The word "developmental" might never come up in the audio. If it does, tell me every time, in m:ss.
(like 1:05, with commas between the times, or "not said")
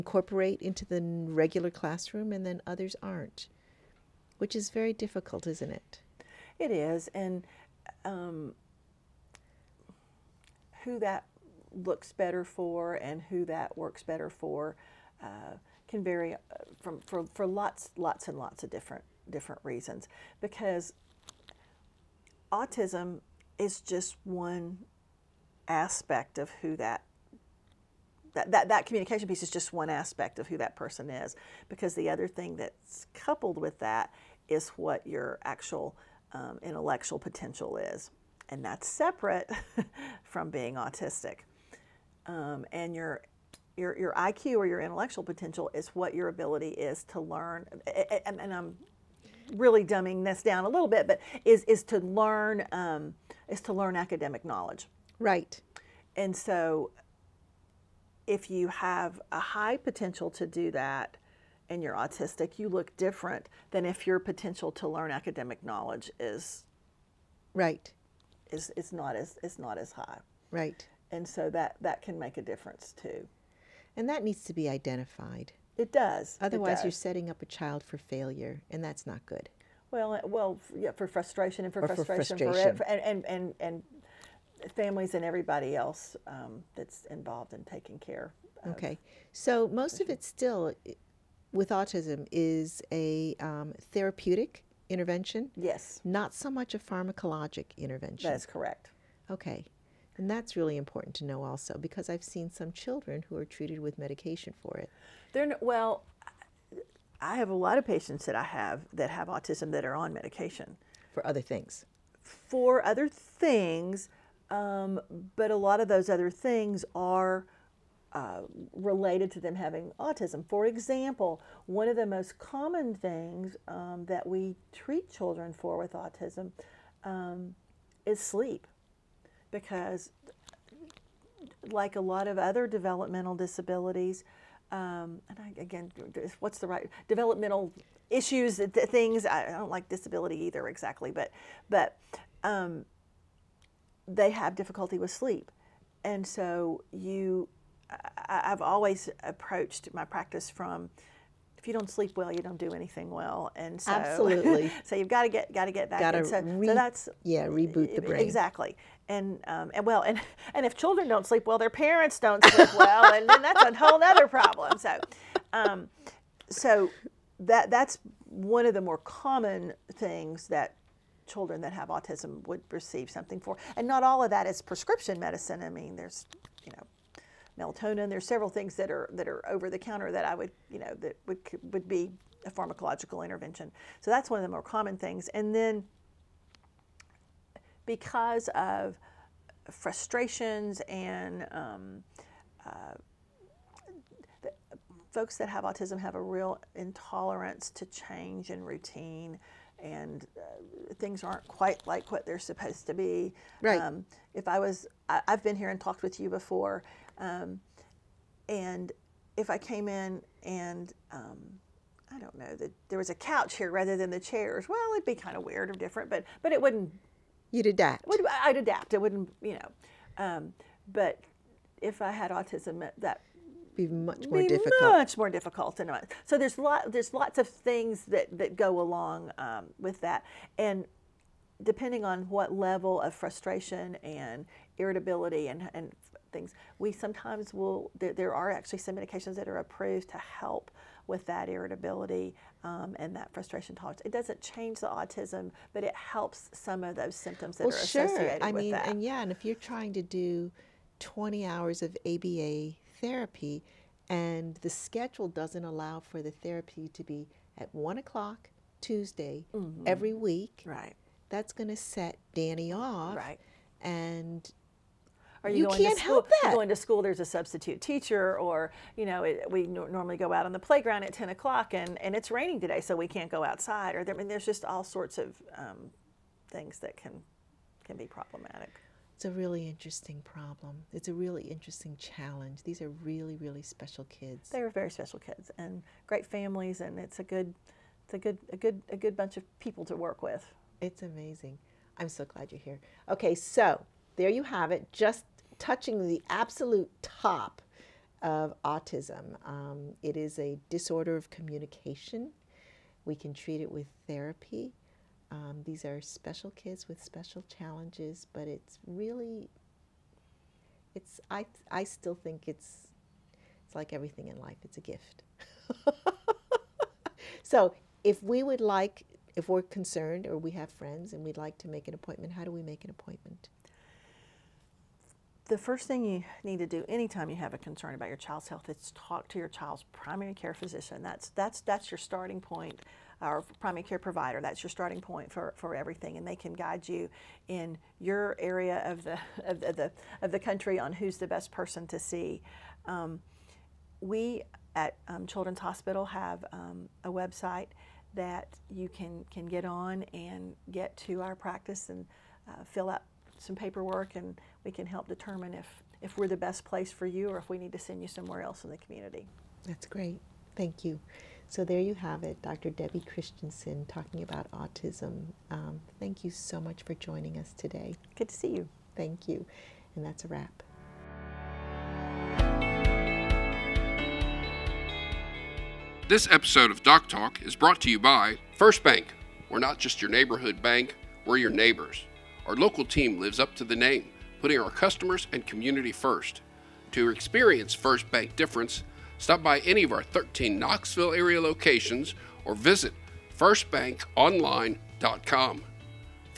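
2:12, 2:17.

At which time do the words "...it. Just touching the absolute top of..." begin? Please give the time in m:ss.
4:54.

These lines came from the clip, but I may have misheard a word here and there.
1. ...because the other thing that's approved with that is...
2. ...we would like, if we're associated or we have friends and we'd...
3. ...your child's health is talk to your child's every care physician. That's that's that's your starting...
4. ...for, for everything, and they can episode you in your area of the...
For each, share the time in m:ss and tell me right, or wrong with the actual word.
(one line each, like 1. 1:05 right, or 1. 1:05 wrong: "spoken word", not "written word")
1. 0:31 wrong: "coupled", not "approved"
2. 5:18 wrong: "concerned", not "associated"
3. 5:28 wrong: "primary", not "every"
4. 5:35 wrong: "guide", not "episode".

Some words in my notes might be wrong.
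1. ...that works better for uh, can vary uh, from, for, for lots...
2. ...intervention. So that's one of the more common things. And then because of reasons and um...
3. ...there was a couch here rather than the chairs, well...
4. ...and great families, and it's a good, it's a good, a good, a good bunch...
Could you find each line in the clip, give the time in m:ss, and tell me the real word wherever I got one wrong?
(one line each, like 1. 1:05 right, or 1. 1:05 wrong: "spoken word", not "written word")
1. 0:13 right
2. 3:03 wrong: "frustrations", not "reasons"
3. 3:32 right
4. 4:45 right.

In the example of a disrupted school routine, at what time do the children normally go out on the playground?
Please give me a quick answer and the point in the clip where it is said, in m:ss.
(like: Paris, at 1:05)
10 o'clock, at 4:31.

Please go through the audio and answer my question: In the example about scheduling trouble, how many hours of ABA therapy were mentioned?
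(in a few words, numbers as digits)
20.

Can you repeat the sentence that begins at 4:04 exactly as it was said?
It doesn't change the autism, but it helps some of those symptoms that well, are sure.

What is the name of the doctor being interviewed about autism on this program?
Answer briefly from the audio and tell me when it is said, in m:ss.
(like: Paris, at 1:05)
Debbie Christiansen, at 6:02.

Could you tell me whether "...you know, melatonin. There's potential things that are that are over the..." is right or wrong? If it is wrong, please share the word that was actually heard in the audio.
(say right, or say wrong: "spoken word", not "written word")
wrong: "several", not "potential".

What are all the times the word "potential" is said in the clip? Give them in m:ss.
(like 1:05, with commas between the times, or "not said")
0:37, 0:45, 0:59, 1:04.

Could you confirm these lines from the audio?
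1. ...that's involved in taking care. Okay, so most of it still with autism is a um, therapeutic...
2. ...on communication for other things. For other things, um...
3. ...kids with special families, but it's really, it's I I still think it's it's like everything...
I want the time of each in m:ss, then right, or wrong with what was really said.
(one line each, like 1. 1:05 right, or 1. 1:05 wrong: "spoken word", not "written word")
1. 1:26 right
2. 1:49 wrong: "medication", not "communication"
3. 5:06 wrong: "challenges", not "families".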